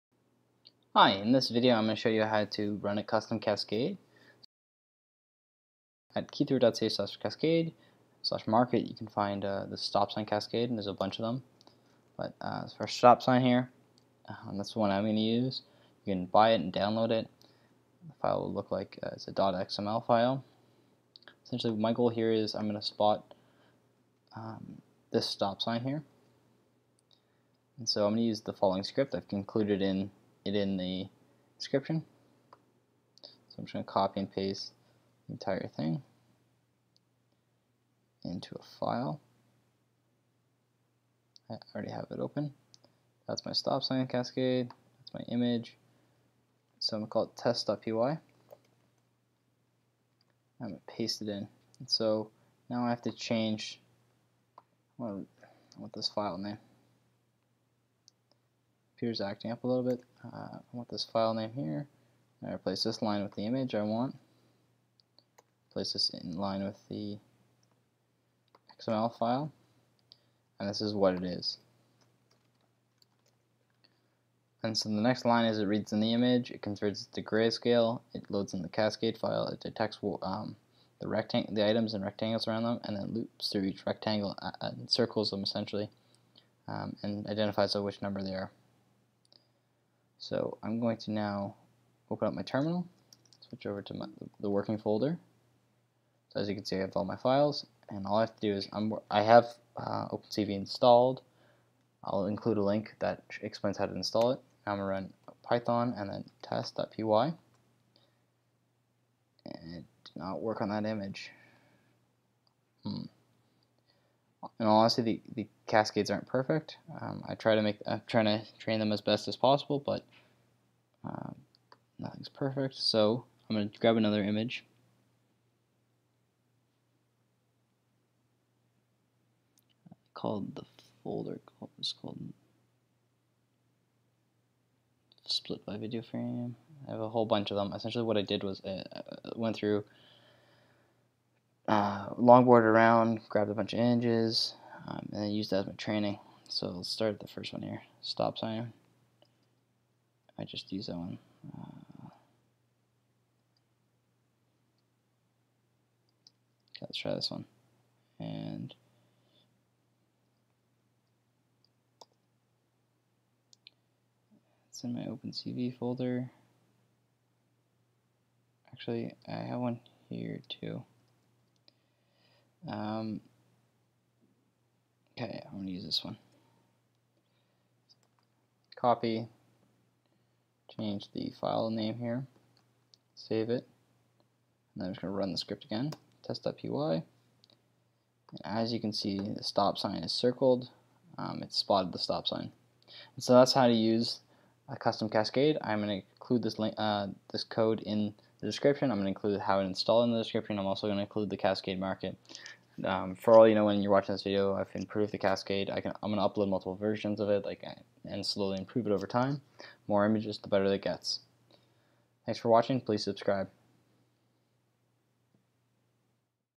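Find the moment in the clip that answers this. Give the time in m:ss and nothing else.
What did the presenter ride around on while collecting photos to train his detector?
2:22.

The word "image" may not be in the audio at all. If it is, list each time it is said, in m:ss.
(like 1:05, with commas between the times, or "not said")
0:45, 1:03, 1:16, 1:50, 2:04, 2:23, 3:30.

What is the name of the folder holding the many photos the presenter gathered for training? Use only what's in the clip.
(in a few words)
split by video frame.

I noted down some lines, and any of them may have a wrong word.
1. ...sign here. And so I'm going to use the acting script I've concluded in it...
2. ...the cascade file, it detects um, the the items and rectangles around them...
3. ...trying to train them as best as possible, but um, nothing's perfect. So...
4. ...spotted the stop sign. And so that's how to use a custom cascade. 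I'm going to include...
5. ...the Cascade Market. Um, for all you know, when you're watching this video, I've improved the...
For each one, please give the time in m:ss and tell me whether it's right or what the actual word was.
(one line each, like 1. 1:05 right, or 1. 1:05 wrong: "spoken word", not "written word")
1. 0:25 wrong: "following", not "acting"
2. 1:18 right
3. 1:58 right
4. 3:11 right
5. 3:21 right.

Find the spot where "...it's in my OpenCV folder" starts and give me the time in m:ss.
2:44.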